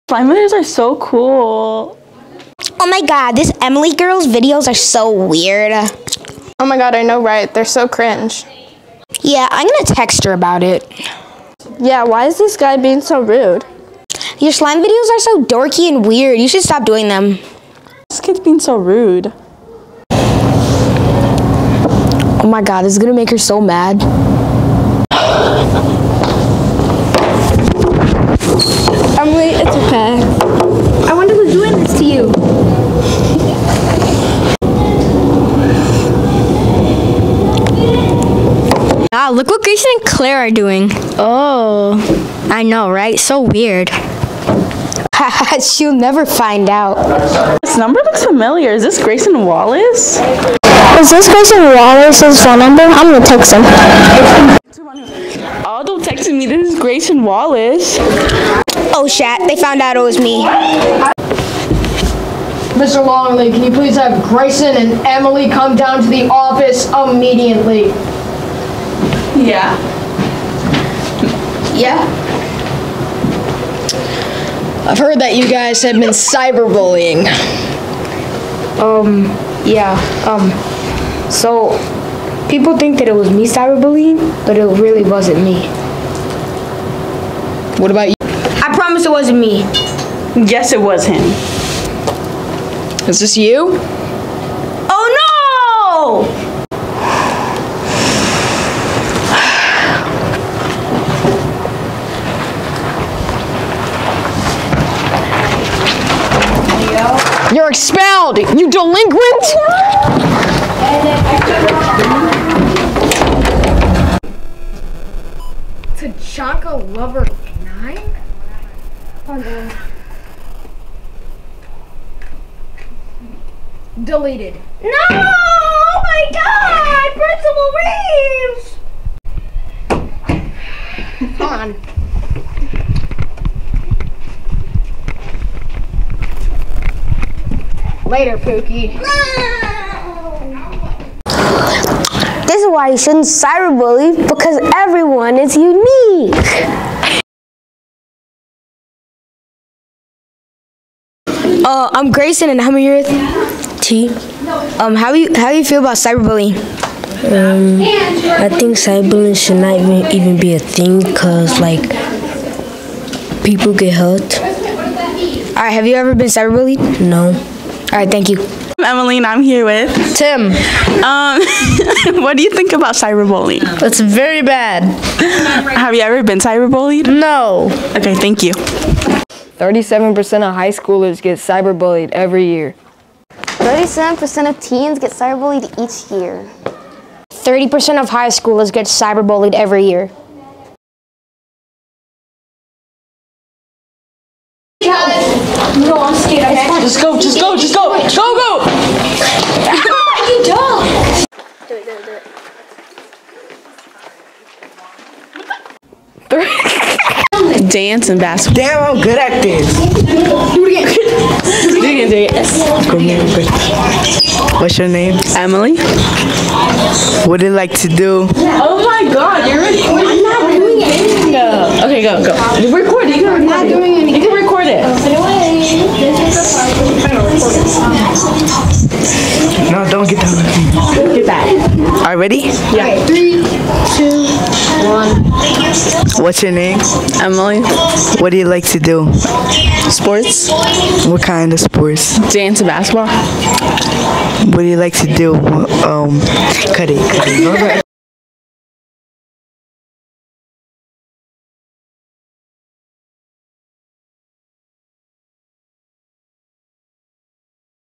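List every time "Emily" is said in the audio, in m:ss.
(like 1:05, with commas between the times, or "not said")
0:03, 0:29, 1:05, 3:35, 3:57.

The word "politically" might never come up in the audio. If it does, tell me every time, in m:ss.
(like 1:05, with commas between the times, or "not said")
not said.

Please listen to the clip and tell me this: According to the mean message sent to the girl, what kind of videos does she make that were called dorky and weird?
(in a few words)
slime videos.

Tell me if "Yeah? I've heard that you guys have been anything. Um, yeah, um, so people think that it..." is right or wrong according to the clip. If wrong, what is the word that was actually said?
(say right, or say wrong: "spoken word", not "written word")
wrong: "cyberbullying", not "anything".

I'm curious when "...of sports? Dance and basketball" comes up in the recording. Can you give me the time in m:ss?
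4:01.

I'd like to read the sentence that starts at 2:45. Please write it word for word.
All right, have you ever been cyberbullied?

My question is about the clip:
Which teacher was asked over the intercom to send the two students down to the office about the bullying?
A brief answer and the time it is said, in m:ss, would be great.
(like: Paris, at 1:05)
Mr. Longley, at 1:02.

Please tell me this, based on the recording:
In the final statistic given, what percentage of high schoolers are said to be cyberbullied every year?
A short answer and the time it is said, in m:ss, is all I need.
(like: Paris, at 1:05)
30%, at 3:07.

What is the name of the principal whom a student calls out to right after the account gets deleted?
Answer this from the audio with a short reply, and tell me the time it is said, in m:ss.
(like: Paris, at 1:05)
Principal Reeves, at 2:10.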